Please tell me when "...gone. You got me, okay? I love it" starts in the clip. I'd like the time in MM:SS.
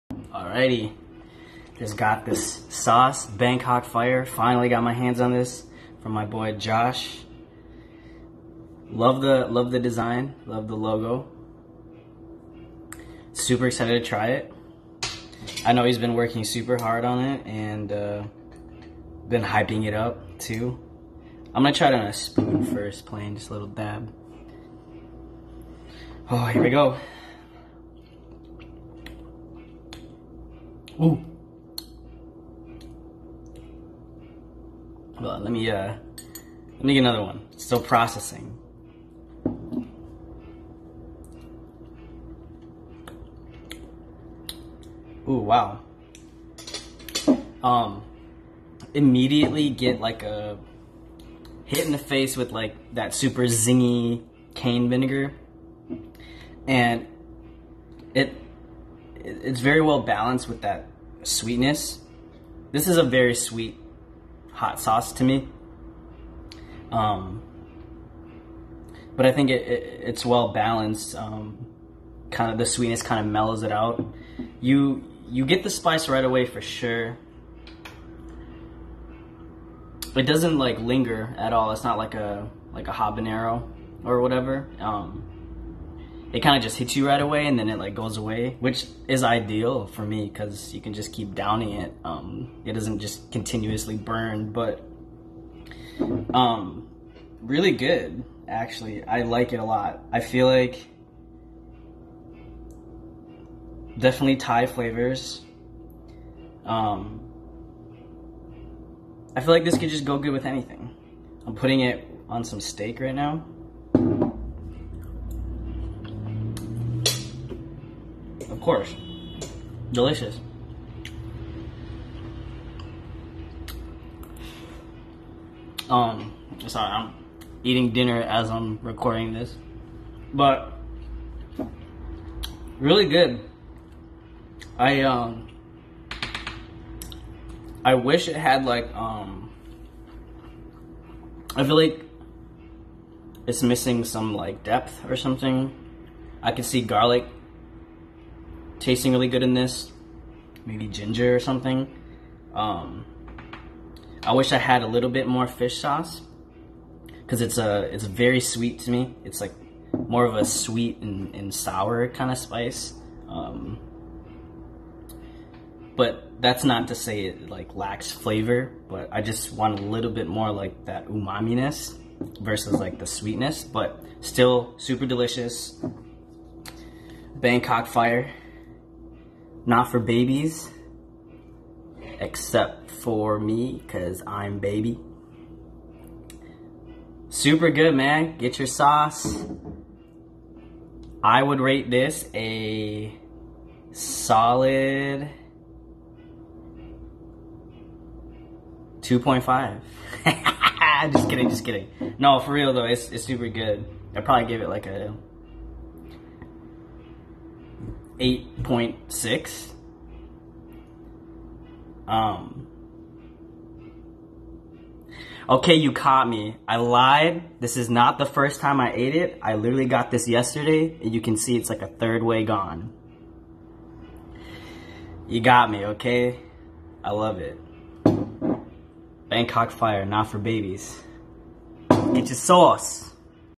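03:42.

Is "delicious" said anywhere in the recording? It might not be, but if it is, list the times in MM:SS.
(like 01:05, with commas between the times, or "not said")
01:59, 02:55.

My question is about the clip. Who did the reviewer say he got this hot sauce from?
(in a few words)
Josh.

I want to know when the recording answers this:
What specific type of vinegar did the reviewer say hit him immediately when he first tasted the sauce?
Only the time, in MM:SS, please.
00:54.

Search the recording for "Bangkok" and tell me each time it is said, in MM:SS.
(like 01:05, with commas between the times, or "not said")
00:03, 02:57, 03:49.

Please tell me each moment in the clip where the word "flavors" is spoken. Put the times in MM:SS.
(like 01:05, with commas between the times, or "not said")
01:44, 02:48.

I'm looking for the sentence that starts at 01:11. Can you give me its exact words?
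Um, kind of the sweetness kind of mellows it out.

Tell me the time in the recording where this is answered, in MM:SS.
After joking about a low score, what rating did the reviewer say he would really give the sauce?
03:28.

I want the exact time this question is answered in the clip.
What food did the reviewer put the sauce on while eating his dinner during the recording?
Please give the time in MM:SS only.
01:52.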